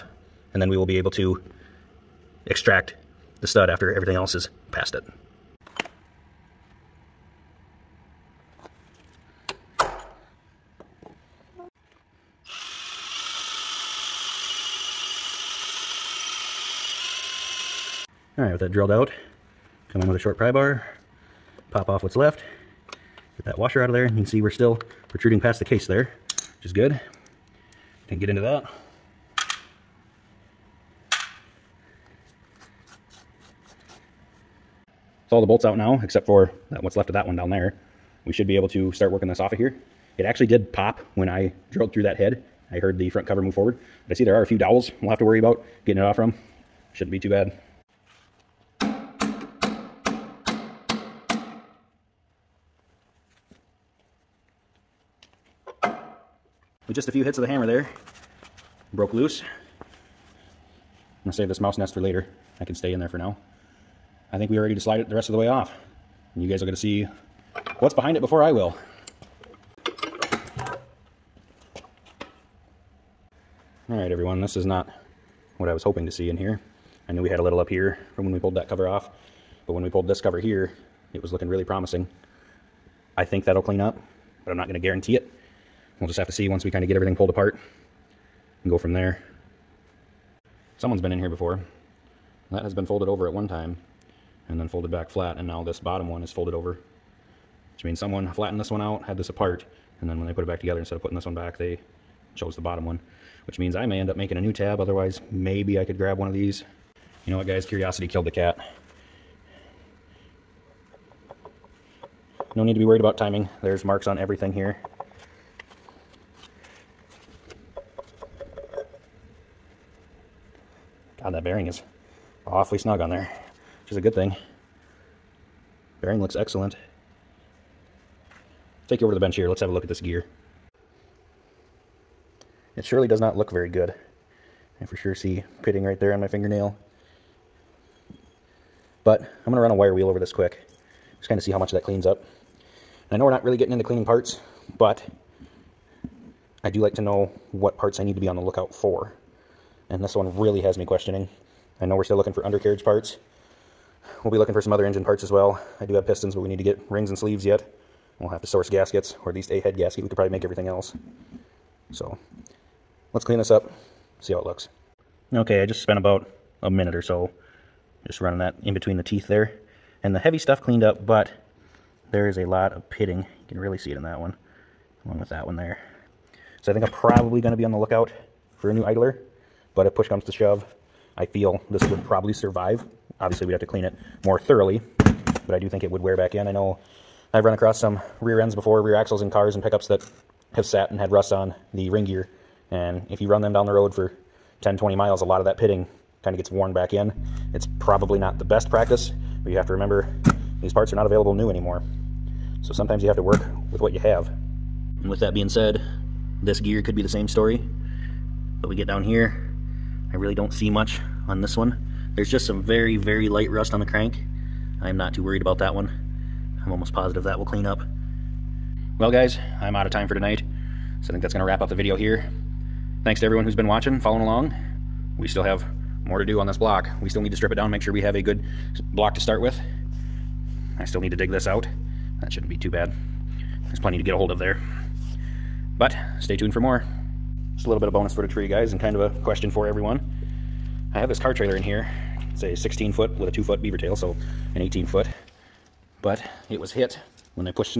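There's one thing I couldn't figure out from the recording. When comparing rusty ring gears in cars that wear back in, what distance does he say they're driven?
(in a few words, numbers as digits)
10, 20 miles.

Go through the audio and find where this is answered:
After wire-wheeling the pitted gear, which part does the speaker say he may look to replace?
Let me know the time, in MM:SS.
02:58.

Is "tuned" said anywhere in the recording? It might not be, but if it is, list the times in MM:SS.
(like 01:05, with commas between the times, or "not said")
03:56.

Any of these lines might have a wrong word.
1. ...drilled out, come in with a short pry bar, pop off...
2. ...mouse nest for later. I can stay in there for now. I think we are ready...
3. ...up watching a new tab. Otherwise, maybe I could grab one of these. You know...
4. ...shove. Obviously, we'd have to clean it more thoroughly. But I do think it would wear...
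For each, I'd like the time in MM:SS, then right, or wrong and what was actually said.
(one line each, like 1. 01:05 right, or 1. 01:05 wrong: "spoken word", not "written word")
1. 00:18 right
2. 01:01 right
3. 01:44 wrong: "making", not "watching"
4. 03:02 wrong: "survive", not "shove".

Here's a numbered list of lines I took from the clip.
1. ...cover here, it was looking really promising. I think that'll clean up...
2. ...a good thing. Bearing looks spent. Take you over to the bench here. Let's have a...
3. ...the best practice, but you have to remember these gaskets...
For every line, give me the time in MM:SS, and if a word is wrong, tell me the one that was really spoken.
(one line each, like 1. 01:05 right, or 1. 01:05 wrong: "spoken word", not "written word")
1. 01:20 right
2. 02:03 wrong: "excellent", not "spent"
3. 03:18 wrong: "parts", not "gaskets".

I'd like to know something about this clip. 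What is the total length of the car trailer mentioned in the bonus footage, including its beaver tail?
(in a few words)
18 foot.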